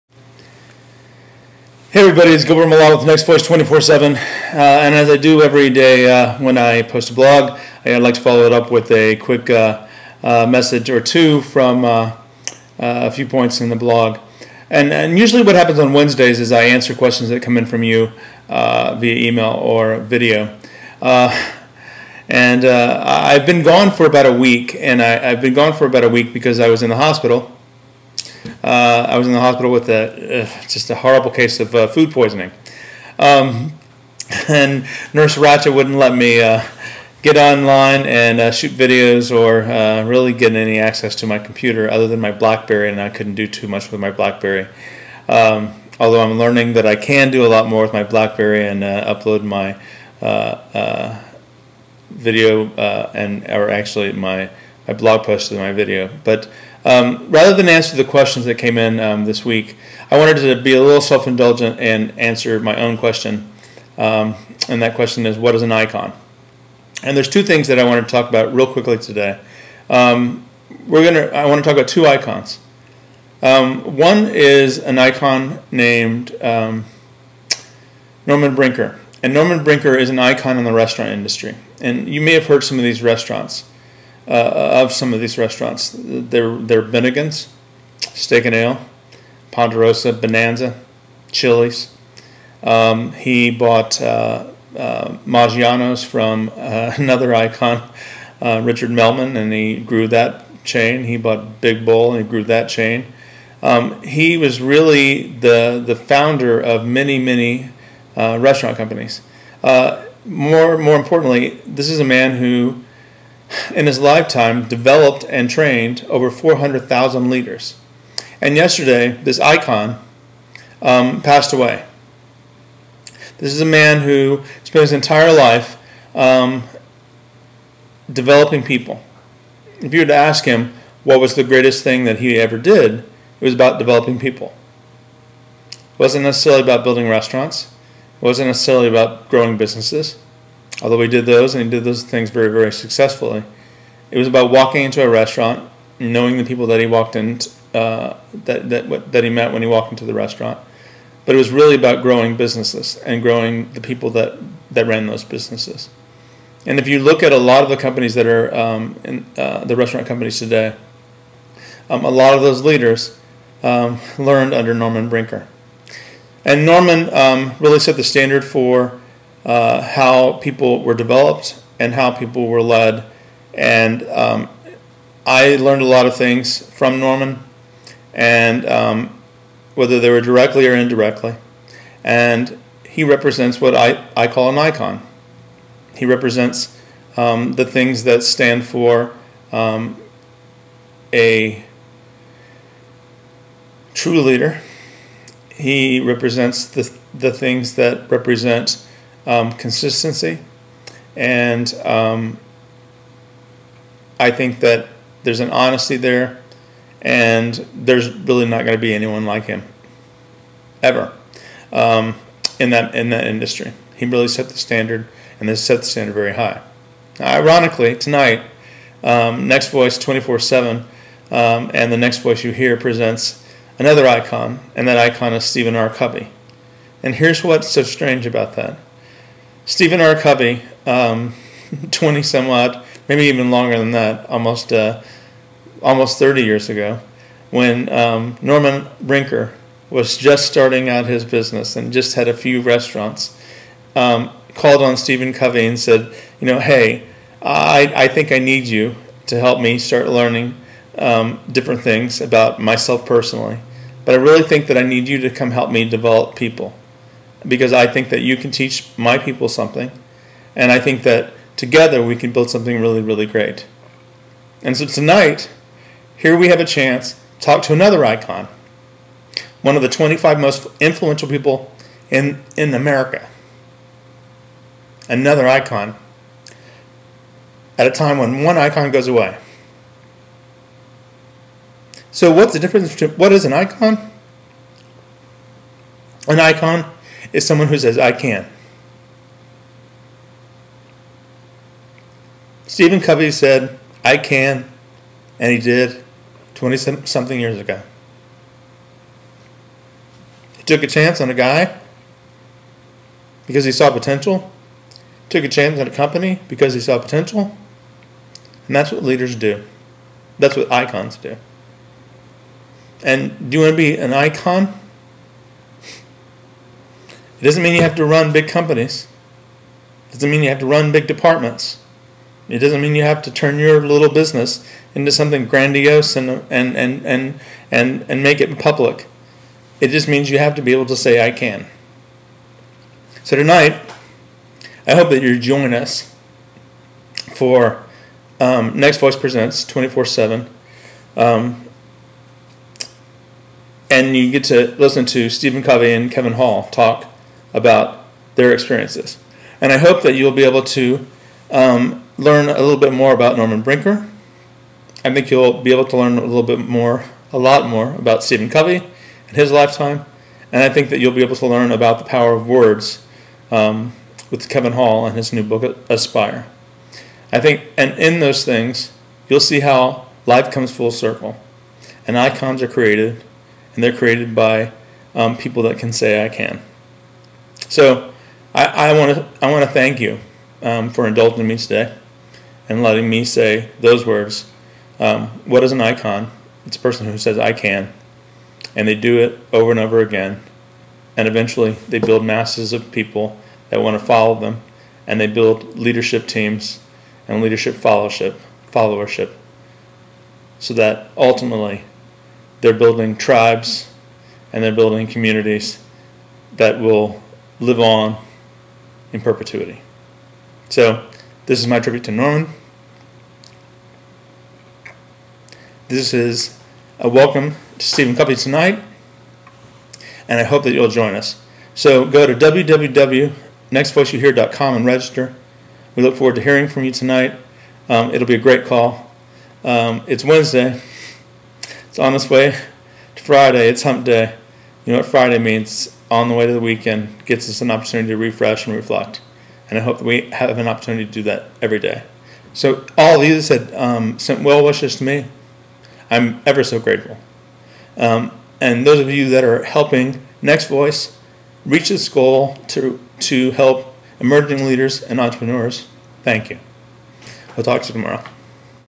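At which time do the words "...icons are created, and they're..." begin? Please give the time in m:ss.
6:12.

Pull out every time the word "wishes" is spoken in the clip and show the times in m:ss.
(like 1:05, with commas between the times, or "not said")
7:24.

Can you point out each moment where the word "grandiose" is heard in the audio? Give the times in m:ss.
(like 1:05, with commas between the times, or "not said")
5:25.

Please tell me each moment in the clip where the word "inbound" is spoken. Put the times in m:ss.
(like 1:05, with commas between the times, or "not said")
not said.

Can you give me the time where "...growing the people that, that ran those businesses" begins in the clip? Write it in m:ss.
2:33.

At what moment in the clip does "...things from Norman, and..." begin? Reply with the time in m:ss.
2:56.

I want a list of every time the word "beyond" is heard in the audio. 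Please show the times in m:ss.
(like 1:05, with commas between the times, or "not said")
not said.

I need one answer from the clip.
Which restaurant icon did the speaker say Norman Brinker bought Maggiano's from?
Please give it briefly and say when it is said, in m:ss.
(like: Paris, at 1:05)
Richard Melman, at 1:38.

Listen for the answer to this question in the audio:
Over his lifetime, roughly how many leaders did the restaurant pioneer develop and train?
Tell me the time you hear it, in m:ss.
1:56.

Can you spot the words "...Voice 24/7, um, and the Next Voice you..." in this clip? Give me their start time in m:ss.
3:39.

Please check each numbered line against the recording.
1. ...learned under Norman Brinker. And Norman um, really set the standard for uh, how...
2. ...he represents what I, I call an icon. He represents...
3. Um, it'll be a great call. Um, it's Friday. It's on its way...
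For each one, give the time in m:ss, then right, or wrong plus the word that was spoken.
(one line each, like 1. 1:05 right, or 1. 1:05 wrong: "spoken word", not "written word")
1. 2:44 right
2. 3:02 right
3. 7:07 wrong: "Wednesday", not "Friday".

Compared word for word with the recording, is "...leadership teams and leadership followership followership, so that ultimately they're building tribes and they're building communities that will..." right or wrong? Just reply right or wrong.
right.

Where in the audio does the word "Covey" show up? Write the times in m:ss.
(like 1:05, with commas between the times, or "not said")
3:45, 3:50, 4:05, 4:53, 5:45, 5:58, 6:58.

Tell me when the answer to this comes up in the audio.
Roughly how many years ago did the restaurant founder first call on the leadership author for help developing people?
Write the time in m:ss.
3:55.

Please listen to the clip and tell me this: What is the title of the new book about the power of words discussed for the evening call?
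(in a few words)
Aspire.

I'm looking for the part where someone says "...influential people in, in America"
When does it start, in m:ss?
4:30.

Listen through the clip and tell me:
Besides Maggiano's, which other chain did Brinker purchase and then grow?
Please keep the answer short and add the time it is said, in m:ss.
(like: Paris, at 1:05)
Big Bowl, at 1:41.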